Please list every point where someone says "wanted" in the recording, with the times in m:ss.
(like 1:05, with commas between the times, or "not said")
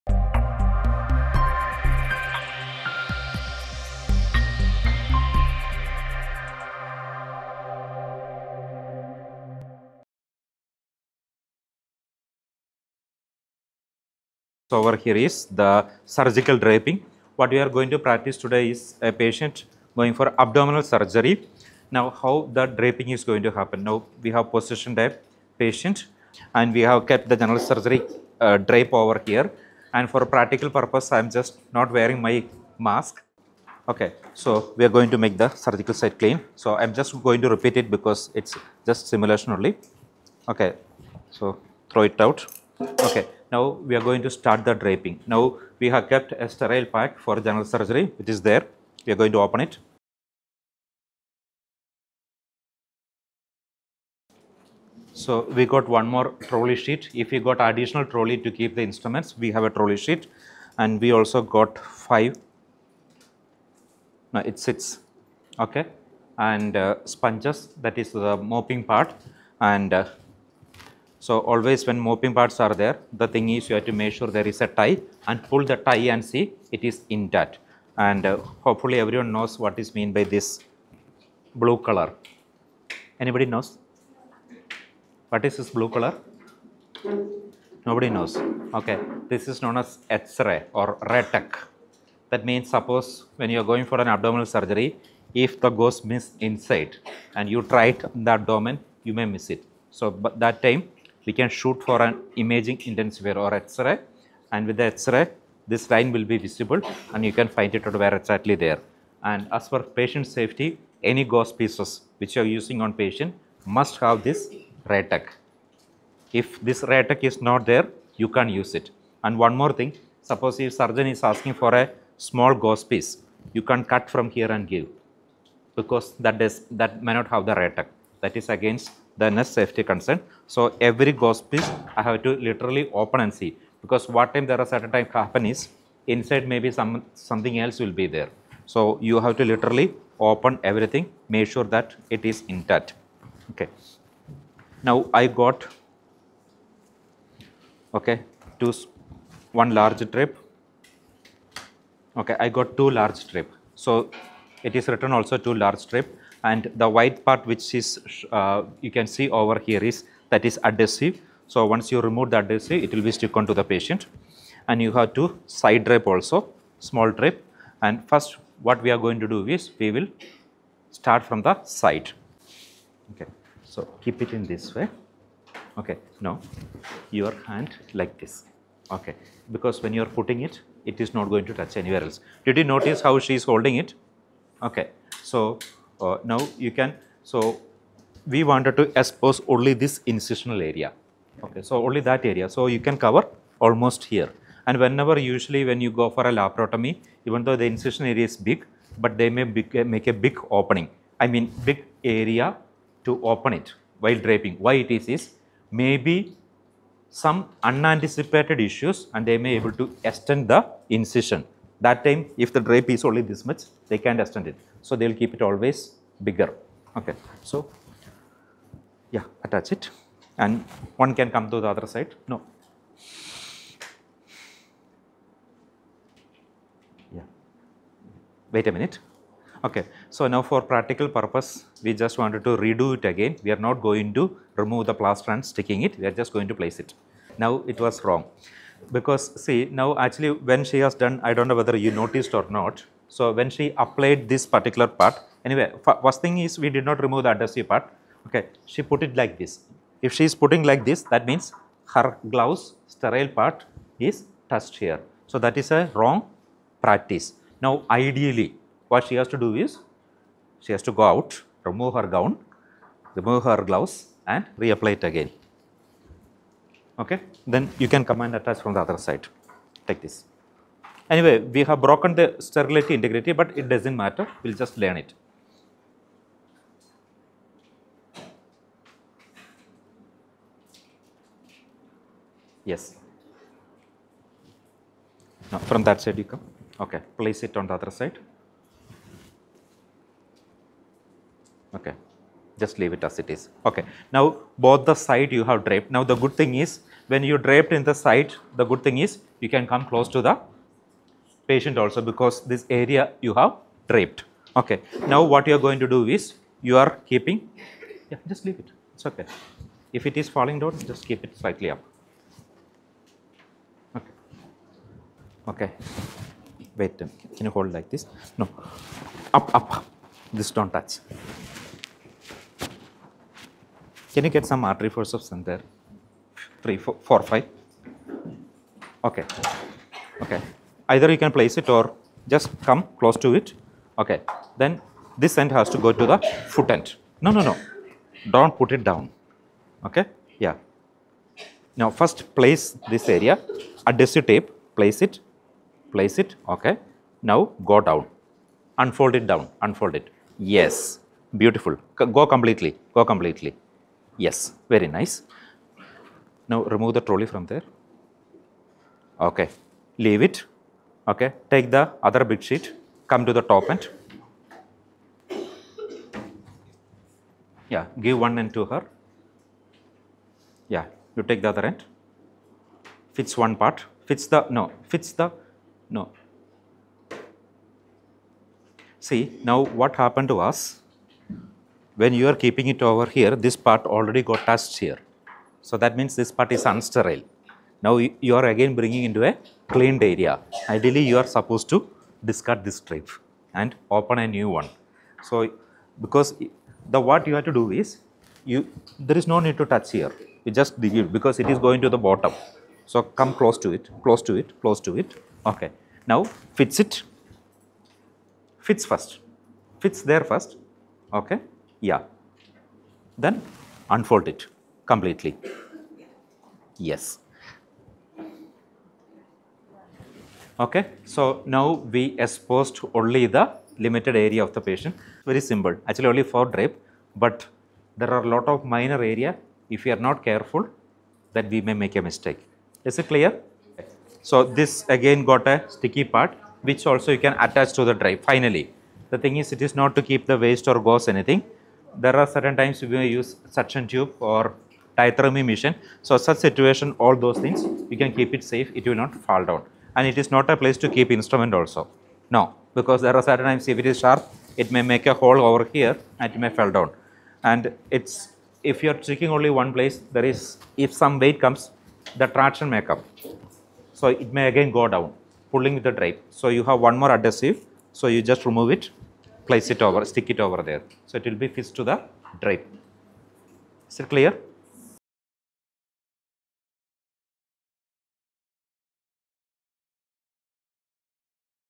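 3:08, 3:52.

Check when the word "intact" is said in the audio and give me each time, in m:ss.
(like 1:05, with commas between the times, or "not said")
1:17, 2:22.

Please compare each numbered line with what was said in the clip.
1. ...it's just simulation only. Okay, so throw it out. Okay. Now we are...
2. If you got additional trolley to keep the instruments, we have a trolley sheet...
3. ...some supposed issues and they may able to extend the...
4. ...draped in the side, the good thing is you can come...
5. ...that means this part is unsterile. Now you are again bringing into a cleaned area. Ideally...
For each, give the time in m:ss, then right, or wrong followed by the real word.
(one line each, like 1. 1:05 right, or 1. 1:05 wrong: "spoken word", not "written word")
1. 0:38 right
2. 0:57 right
3. 3:27 wrong: "unanticipated", not "supposed"
4. 4:57 right
5. 6:25 right.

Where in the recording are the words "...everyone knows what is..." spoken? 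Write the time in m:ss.
1:18.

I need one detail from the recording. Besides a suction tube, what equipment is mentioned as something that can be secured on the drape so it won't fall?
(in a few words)
Diathermy machine.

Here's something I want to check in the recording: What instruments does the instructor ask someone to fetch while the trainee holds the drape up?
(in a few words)
Artery forceps.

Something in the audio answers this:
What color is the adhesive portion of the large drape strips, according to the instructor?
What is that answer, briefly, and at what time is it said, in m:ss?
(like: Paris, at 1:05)
White, at 2:36.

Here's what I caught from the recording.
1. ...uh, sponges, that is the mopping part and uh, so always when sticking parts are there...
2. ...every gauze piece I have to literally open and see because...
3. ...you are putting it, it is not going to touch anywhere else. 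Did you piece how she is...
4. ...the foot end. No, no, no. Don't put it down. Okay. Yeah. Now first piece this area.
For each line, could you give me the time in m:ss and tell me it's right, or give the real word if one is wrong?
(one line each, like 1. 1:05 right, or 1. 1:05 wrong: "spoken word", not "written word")
1. 1:06 wrong: "moping", not "sticking"
2. 2:10 right
3. 2:59 wrong: "notice", not "piece"
4. 5:36 wrong: "place", not "piece".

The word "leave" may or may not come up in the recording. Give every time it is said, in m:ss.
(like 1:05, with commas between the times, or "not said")
4:52, 5:08, 5:59.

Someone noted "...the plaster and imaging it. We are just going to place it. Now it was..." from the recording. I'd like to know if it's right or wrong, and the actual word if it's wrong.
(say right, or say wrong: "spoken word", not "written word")
wrong: "sticking", not "imaging".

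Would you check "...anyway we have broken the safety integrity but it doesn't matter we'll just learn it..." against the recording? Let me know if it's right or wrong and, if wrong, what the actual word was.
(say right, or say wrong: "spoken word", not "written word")
wrong: "sterility", not "safety".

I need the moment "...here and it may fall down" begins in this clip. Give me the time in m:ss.
7:35.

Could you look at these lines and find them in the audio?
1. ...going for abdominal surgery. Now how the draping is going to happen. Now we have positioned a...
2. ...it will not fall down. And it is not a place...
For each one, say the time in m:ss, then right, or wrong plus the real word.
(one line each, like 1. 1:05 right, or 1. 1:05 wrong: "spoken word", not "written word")
1. 0:19 right
2. 7:28 right.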